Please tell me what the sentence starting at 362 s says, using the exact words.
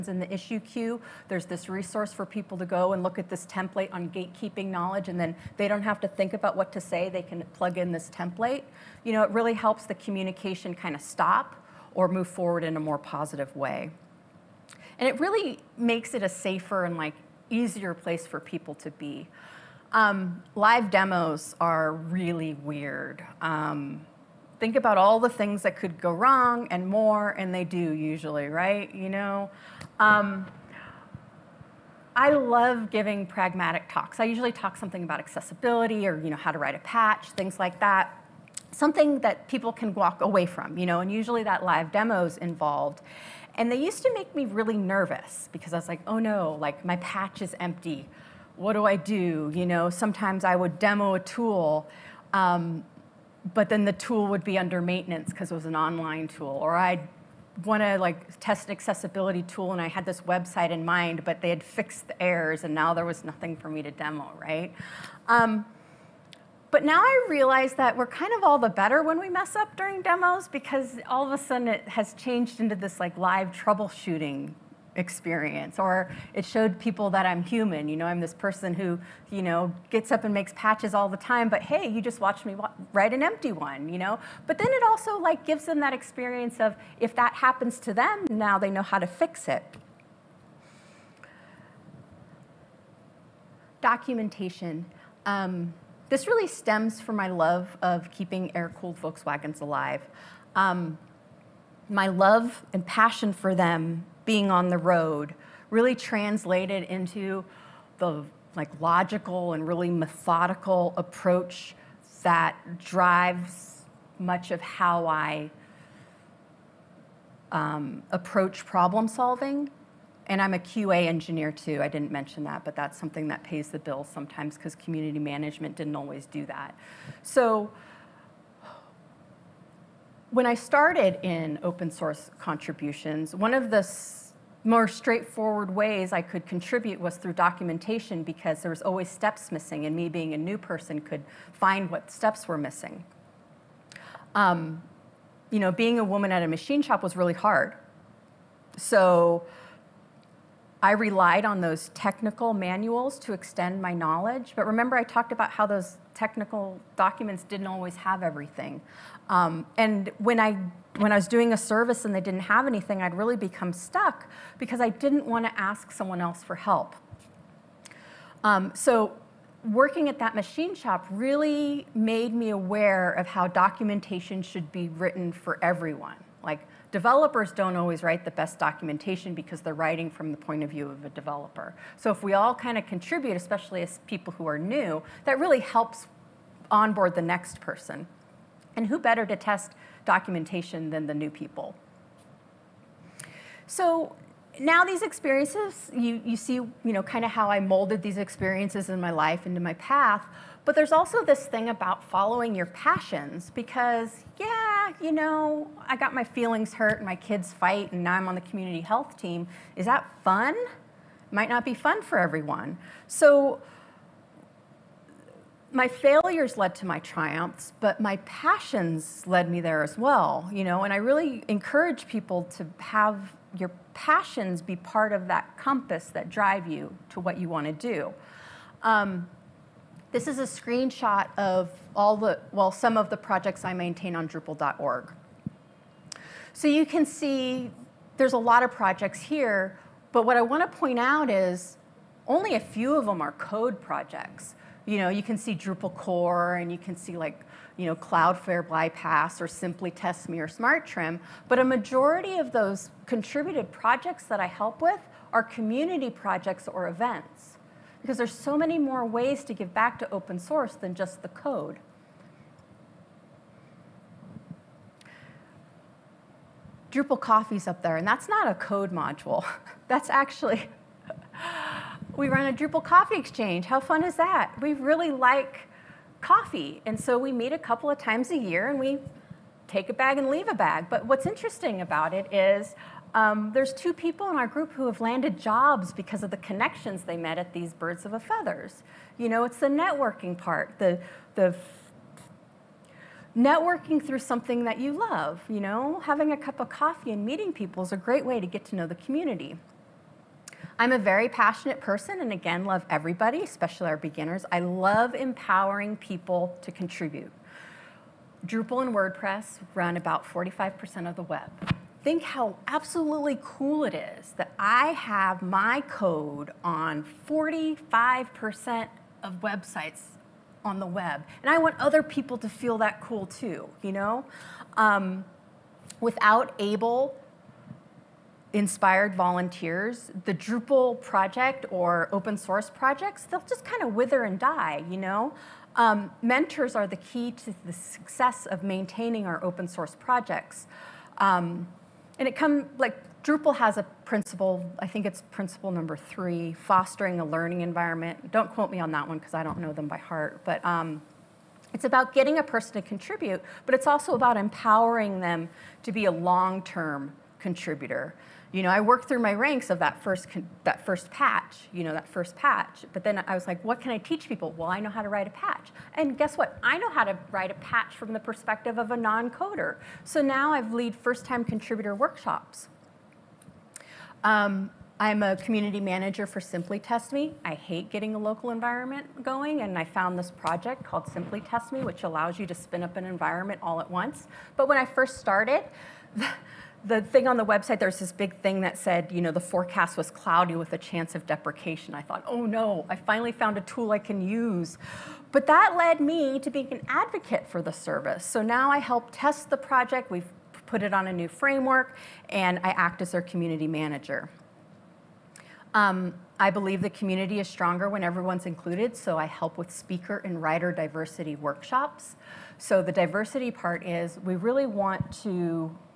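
But then I was like, what can I teach people?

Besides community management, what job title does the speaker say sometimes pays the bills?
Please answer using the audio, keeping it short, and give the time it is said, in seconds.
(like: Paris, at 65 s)
QA engineer, at 120 s.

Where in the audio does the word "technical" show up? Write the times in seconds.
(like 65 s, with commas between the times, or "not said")
151 s, 156 s.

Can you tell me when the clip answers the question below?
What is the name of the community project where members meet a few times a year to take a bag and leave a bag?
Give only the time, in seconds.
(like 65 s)
272 s.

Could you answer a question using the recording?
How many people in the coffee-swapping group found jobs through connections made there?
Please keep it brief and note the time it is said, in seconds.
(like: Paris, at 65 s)
2, at 283 s.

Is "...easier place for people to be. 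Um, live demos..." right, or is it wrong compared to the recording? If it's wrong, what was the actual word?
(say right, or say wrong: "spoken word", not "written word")
right.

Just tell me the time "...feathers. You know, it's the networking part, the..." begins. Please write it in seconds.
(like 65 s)
288 s.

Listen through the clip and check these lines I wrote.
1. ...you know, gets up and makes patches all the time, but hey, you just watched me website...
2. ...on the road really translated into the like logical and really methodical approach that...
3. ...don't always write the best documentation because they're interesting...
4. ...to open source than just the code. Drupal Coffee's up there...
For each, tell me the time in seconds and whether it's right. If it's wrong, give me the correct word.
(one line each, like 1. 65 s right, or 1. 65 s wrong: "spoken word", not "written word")
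1. 79 s wrong: "write", not "website"
2. 104 s right
3. 177 s wrong: "writing", not "interesting"
4. 259 s right.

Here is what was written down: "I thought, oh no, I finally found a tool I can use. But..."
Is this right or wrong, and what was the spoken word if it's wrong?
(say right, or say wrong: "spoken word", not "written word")
right.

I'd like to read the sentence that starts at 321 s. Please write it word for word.
And I want other people to feel that cool too, you know?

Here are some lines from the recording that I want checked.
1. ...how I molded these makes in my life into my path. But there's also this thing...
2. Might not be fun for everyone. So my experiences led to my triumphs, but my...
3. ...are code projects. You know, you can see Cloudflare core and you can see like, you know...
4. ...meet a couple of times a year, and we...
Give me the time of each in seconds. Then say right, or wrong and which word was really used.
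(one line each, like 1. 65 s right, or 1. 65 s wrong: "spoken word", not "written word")
1. 197 s wrong: "experiences", not "makes"
2. 211 s wrong: "failures", not "experiences"
3. 243 s wrong: "Drupal", not "Cloudflare"
4. 277 s right.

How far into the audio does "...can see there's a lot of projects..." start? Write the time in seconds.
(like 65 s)
236 s.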